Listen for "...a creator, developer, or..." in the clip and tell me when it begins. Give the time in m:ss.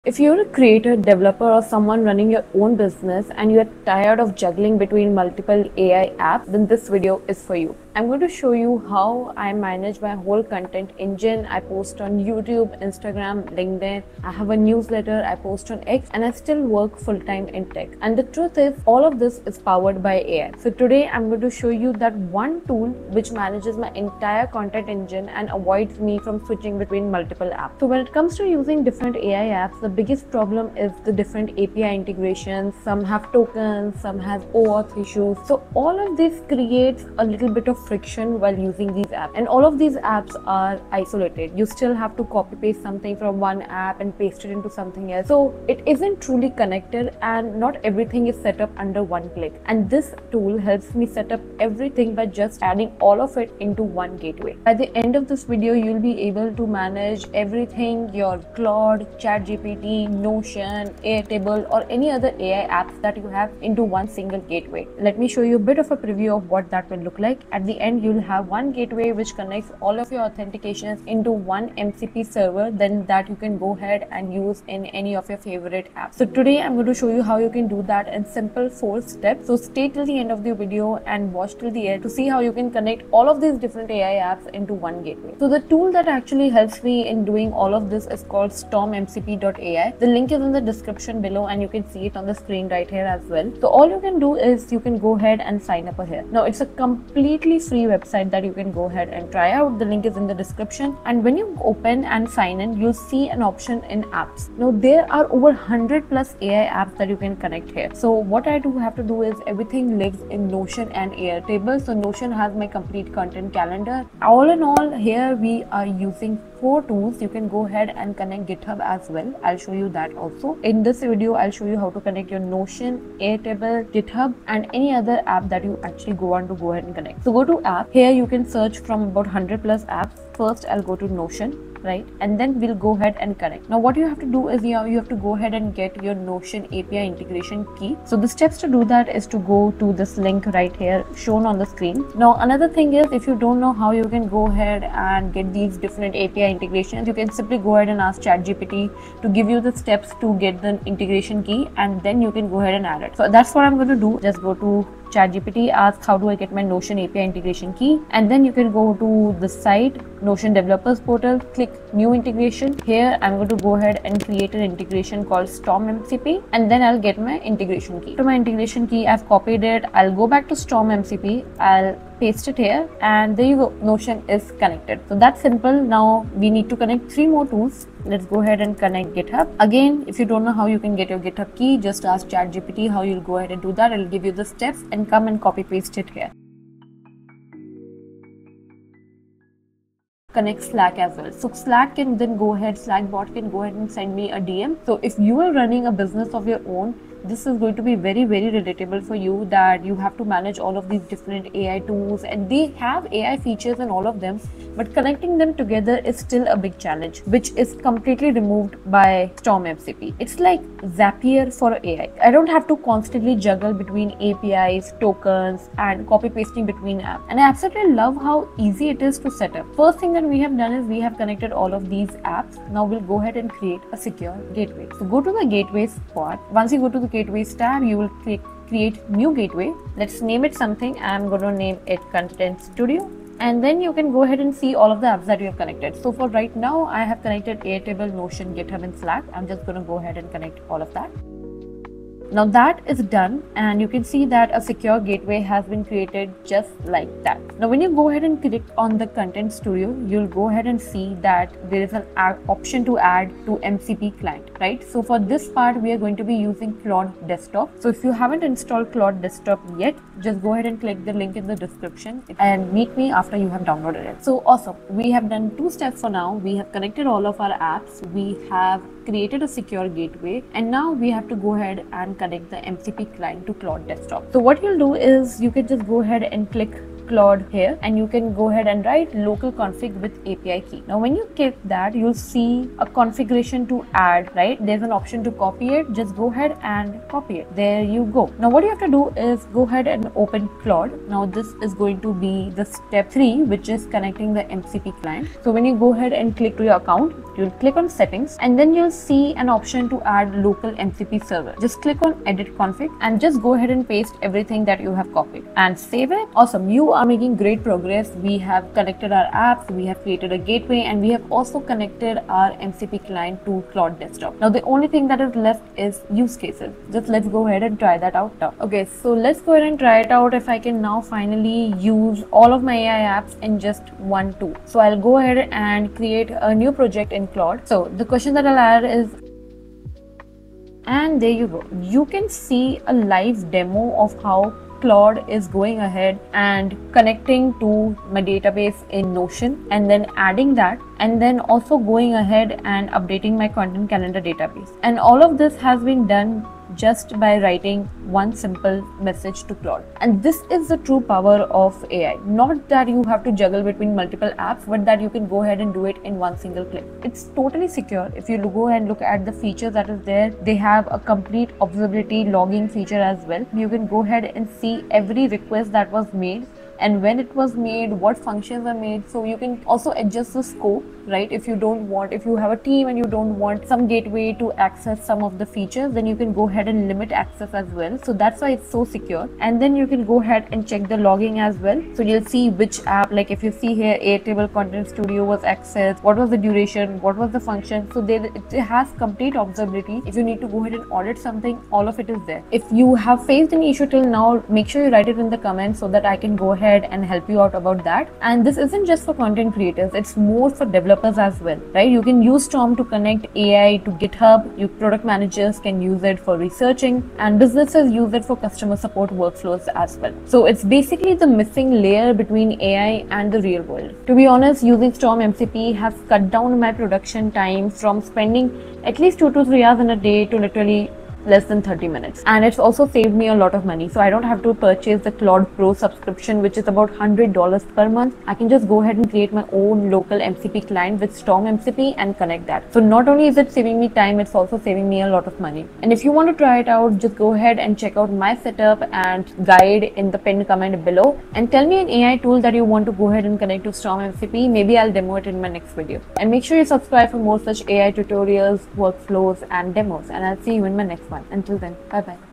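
0:00.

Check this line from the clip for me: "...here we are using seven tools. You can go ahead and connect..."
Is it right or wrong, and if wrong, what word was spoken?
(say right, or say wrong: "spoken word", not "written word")
wrong: "four", not "seven".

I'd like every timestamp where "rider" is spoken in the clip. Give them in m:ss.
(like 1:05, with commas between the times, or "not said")
not said.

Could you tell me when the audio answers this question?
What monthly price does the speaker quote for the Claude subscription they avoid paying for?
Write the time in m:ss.
7:06.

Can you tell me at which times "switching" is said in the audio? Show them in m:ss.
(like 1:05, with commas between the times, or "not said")
0:26.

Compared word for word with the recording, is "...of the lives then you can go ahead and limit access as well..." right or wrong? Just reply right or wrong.
wrong.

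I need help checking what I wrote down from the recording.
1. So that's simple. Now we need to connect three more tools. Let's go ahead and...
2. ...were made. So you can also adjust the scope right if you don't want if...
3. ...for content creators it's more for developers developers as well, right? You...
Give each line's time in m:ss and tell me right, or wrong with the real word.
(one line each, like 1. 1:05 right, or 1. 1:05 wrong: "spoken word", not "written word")
1. 2:55 right
2. 6:08 right
3. 6:39 right.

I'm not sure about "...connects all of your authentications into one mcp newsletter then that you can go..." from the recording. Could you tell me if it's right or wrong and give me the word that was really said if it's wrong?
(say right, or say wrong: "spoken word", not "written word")
wrong: "server", not "newsletter".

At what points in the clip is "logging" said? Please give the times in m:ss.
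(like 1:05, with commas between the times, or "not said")
6:02, 6:20.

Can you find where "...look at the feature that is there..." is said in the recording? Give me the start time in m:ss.
5:58.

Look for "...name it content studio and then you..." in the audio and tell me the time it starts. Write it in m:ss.
3:51.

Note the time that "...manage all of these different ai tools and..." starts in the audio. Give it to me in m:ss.
3:20.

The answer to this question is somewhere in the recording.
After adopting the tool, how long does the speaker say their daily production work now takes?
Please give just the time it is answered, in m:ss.
7:01.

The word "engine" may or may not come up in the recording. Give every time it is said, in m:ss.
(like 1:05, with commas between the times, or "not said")
0:10, 0:24.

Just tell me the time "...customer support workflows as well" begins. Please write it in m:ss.
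6:48.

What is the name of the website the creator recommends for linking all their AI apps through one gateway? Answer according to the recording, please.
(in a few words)
stormmcp.ai.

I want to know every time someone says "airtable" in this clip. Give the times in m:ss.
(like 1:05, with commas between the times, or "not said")
1:01, 1:51, 2:03, 3:57, 6:23.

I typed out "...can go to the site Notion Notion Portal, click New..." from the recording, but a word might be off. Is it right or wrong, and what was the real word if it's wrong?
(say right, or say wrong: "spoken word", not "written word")
wrong: "Developers", not "Notion".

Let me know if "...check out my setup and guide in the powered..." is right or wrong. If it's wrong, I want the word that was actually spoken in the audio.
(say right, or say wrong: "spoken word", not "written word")
wrong: "pinned", not "powered".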